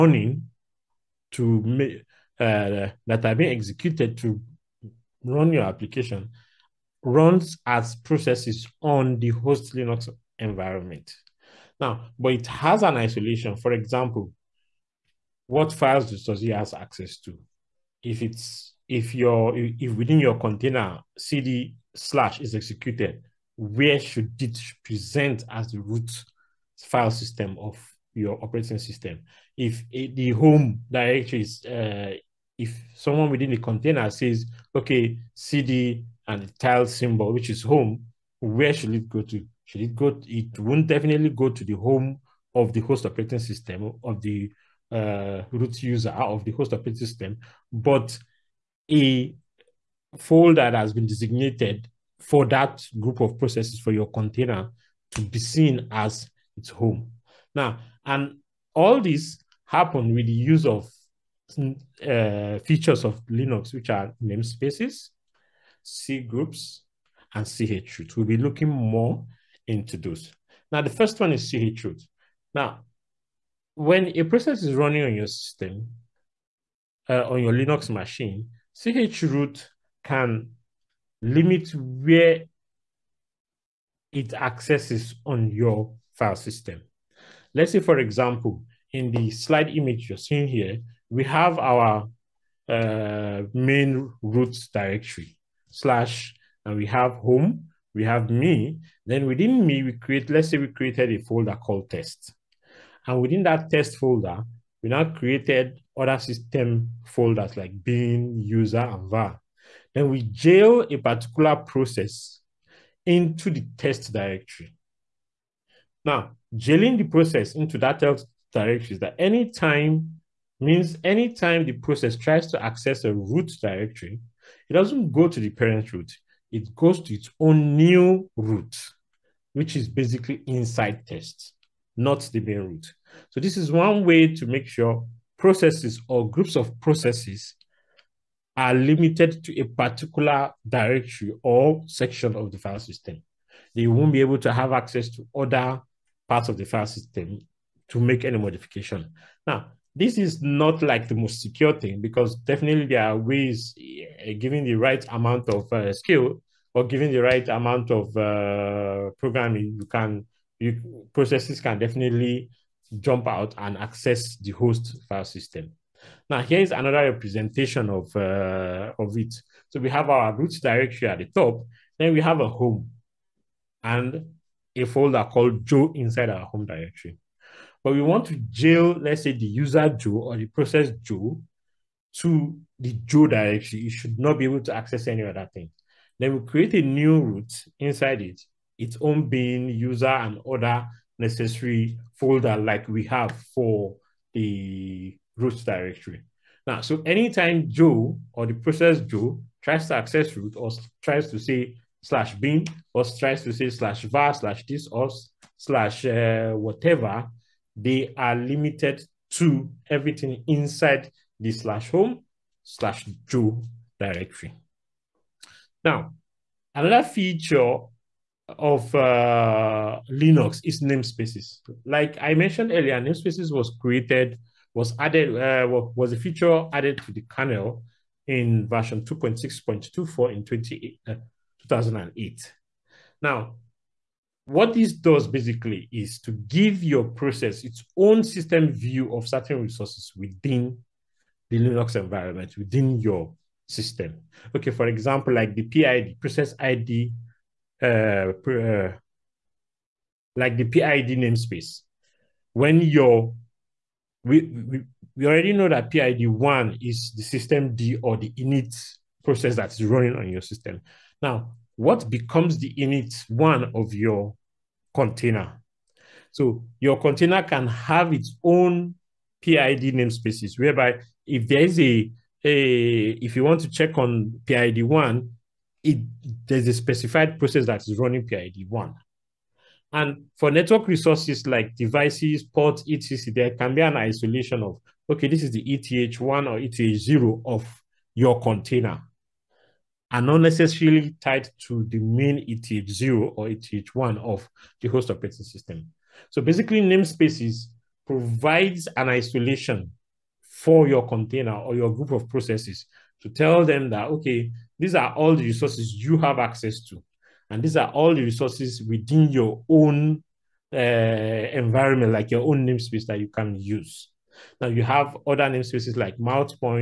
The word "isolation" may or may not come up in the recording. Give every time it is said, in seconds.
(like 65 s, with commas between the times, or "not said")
12 s, 283 s, 299 s.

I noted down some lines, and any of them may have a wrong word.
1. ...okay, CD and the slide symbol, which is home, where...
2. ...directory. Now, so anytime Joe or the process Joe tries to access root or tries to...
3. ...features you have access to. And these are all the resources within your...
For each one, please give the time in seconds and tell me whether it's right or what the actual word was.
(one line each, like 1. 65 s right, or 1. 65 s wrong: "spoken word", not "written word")
1. 34 s wrong: "tilde", not "slide"
2. 195 s right
3. 305 s wrong: "resources", not "features".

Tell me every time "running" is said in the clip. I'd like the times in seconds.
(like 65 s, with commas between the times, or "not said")
74 s, 259 s, 277 s.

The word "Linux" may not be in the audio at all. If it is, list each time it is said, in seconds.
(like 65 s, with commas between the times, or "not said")
9 s, 63 s, 77 s, 220 s, 241 s.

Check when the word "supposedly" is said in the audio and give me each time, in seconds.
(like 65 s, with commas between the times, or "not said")
not said.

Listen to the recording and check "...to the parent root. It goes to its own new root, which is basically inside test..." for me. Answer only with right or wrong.
right.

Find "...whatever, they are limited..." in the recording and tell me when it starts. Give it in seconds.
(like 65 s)
206 s.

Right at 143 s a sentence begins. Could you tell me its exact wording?
They won't be able to have access to other part of the file system to make any modification.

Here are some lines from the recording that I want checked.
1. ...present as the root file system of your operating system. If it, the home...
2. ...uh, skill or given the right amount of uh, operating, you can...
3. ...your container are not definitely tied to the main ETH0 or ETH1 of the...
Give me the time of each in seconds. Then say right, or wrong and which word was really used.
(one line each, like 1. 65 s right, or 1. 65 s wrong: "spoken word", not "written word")
1. 24 s right
2. 155 s wrong: "programming", not "operating"
3. 288 s wrong: "necessarily", not "definitely".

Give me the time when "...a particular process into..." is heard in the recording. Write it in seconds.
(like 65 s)
110 s.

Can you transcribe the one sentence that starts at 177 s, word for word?
But we want to jail, let's say, the user Joe or the process Joe to the Joe directory.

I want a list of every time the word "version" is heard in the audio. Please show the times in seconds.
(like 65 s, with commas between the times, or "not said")
228 s.